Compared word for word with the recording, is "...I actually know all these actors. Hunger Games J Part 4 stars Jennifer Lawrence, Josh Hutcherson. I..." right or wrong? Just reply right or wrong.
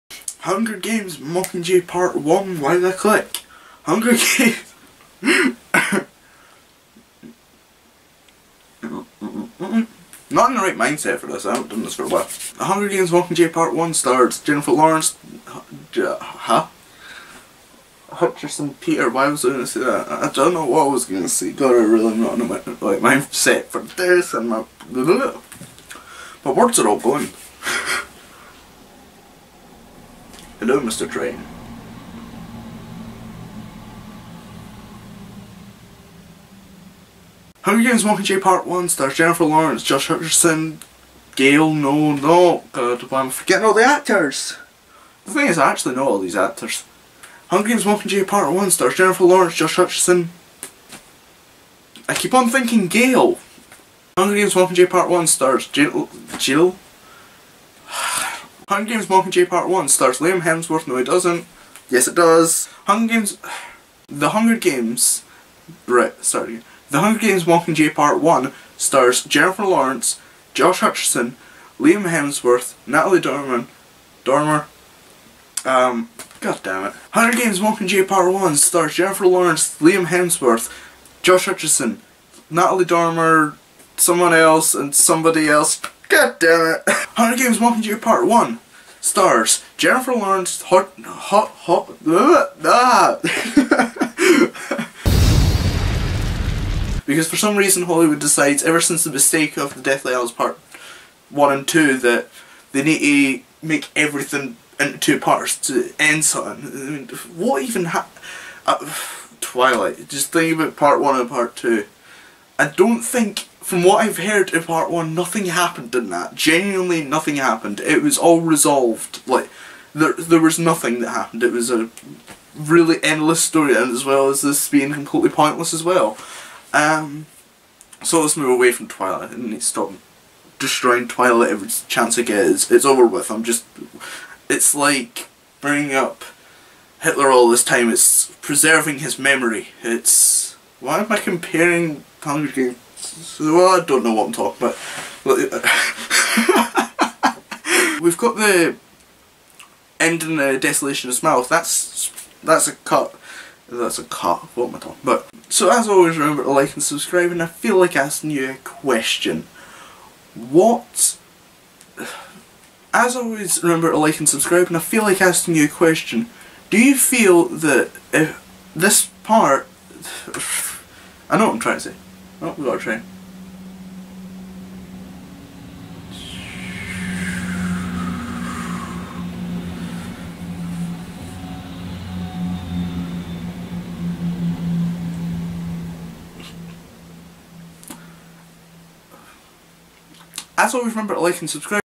wrong.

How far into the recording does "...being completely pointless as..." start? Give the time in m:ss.
2:04.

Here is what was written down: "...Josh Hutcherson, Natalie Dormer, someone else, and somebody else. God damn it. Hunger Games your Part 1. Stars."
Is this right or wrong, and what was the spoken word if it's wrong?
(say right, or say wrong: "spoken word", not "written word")
right.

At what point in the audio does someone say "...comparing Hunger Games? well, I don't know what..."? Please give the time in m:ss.
2:21.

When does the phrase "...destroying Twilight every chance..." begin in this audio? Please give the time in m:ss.
2:10.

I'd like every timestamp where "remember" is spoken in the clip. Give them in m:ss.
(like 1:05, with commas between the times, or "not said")
2:36, 2:43, 3:10.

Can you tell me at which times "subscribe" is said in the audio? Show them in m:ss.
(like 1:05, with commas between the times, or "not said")
2:36, 2:44, 3:11.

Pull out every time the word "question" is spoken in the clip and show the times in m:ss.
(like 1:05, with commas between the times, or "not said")
2:38, 2:45.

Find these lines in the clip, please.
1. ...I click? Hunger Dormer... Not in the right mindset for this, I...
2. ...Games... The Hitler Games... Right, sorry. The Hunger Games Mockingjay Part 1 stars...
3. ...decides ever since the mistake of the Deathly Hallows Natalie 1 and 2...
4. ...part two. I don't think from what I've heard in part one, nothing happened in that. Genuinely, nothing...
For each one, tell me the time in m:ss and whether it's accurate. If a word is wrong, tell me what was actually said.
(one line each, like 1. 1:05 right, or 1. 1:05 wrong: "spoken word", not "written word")
1. 0:02 wrong: "Games", not "Dormer"
2. 1:03 wrong: "Hunger", not "Hitler"
3. 1:38 wrong: "Part", not "Natalie"
4. 1:51 right.